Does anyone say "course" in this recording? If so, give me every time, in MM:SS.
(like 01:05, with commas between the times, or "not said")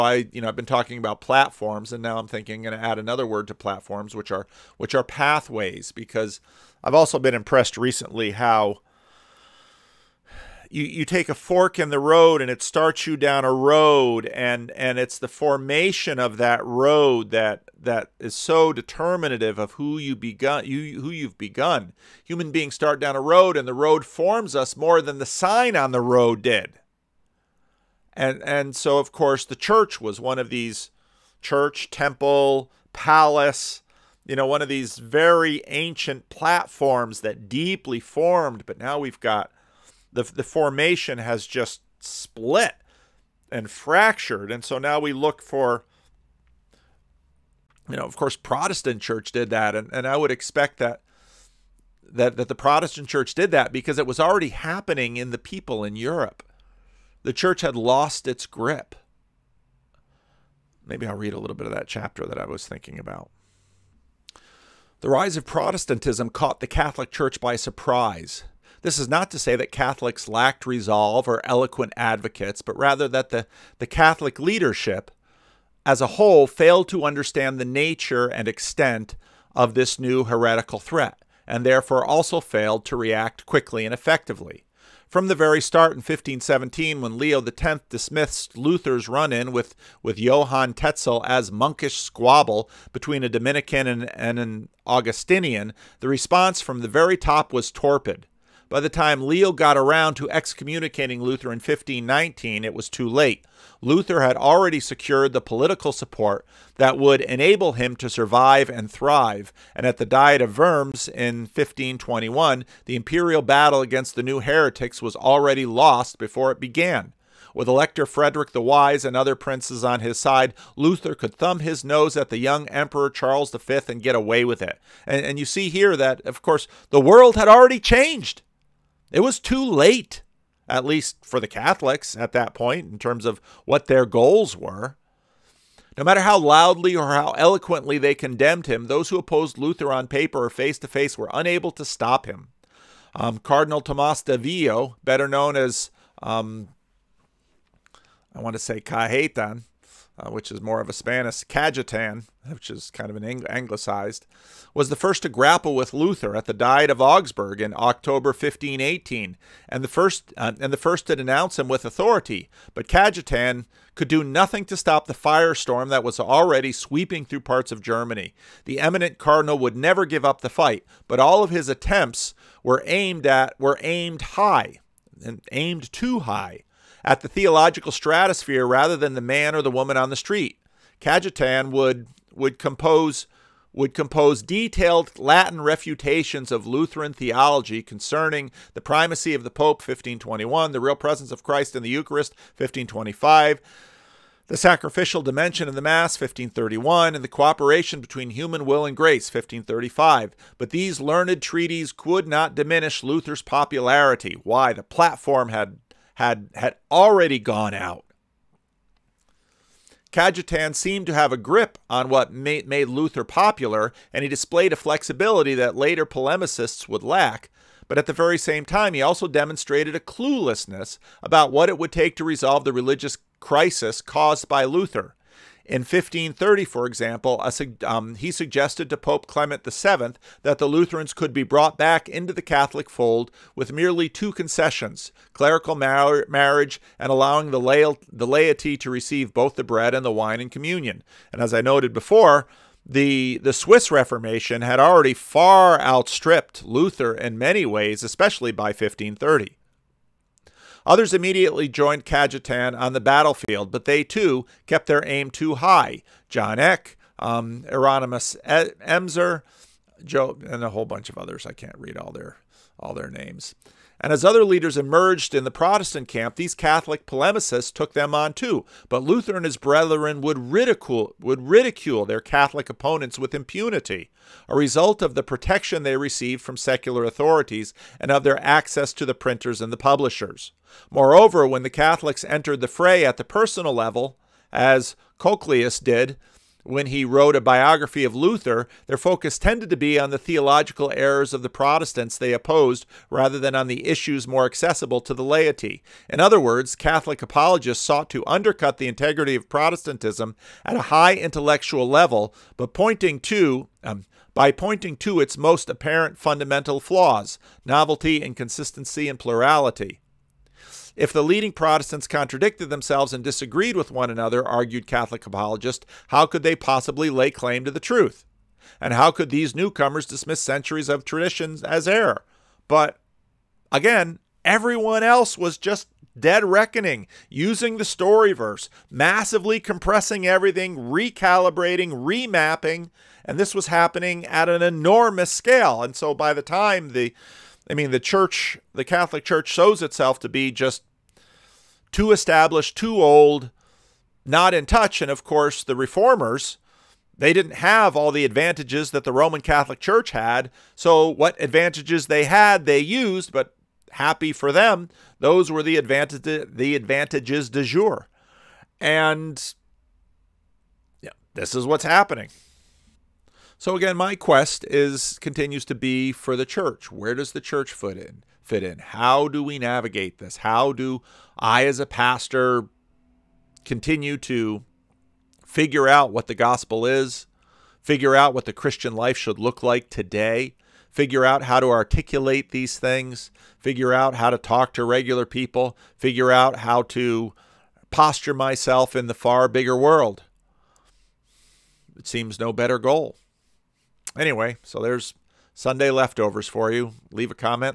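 00:29, 00:48, 02:06, 05:45.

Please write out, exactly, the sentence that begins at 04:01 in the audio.
And as I noted before, the the Swiss Reformation had already far outstripped Luther in many ways, especially by 1530.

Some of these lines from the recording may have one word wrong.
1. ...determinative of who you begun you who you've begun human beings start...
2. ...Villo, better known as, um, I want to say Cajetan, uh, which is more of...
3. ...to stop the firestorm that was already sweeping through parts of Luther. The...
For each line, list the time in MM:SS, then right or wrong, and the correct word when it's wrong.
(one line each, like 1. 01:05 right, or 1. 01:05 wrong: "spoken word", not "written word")
1. 00:18 right
2. 02:24 right
3. 02:44 wrong: "Germany", not "Luther".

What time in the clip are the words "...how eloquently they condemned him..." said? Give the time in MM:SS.
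02:17.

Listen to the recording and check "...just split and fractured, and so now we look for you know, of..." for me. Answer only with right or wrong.
right.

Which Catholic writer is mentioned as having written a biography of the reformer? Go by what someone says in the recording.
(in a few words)
Cochlaeus.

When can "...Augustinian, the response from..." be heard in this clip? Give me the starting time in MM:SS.
01:34.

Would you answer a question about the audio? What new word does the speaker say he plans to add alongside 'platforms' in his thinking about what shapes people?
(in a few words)
pathways.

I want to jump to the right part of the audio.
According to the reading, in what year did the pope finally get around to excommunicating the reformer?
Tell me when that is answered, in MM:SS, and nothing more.
01:41.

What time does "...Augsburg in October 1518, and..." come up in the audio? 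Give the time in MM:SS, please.
02:37.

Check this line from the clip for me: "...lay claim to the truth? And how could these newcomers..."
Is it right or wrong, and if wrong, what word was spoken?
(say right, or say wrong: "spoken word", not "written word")
right.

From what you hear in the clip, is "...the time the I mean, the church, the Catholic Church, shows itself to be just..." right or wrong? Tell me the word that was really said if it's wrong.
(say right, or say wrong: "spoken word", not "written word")
right.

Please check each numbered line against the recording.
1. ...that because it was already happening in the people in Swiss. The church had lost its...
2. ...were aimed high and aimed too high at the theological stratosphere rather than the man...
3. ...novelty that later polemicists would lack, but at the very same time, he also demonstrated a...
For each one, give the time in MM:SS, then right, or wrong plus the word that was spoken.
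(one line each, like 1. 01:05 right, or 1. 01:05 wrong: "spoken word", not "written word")
1. 00:53 wrong: "Europe", not "Swiss"
2. 02:53 right
3. 03:34 wrong: "flexibility", not "novelty".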